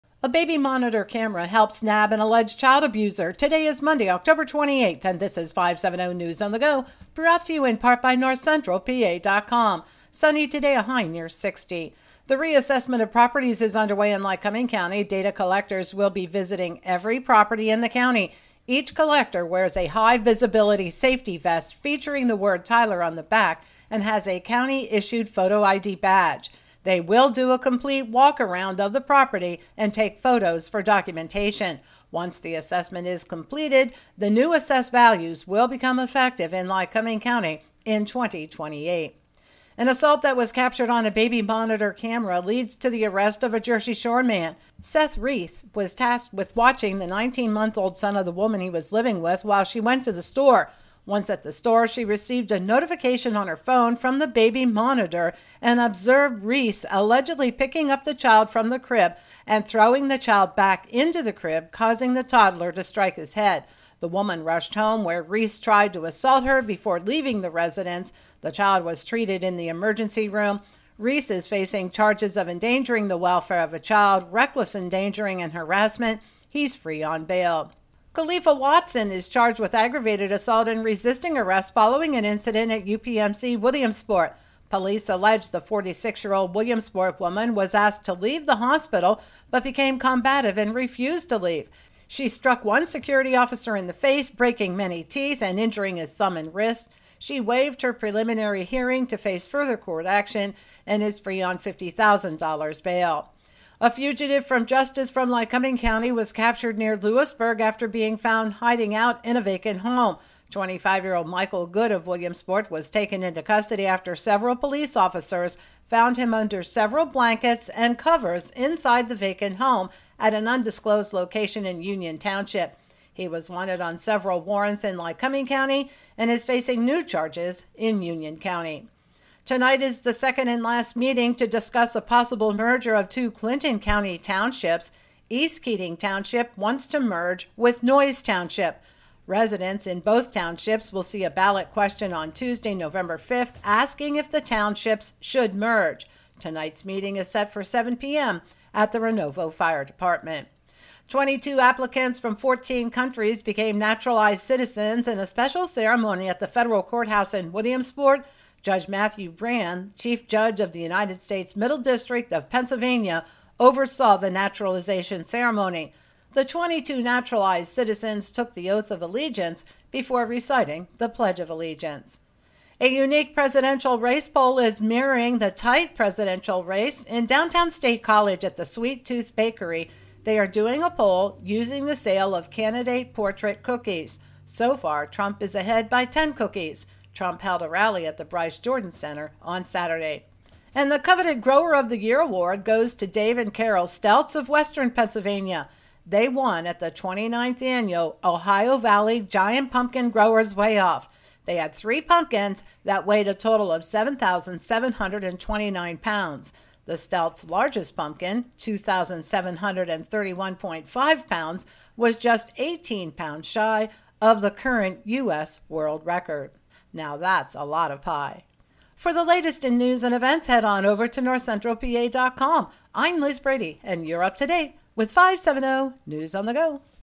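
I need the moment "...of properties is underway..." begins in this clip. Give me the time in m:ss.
0:13.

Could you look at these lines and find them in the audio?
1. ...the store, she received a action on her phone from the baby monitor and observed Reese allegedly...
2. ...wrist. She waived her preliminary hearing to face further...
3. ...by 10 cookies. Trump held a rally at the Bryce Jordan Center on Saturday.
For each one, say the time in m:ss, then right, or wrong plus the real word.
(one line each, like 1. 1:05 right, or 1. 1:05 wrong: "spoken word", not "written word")
1. 0:51 wrong: "notification", not "action"
2. 1:36 right
3. 3:05 right.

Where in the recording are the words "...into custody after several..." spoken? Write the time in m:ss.
1:53.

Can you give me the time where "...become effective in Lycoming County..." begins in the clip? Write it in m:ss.
0:35.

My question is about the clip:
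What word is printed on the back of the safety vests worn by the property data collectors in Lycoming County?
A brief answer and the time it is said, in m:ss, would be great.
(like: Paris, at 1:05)
Tyler, at 0:22.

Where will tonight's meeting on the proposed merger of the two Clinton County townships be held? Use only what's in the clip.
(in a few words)
Renovo Fire Department.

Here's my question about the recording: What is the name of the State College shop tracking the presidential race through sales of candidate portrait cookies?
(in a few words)
Sweet Tooth Bakery.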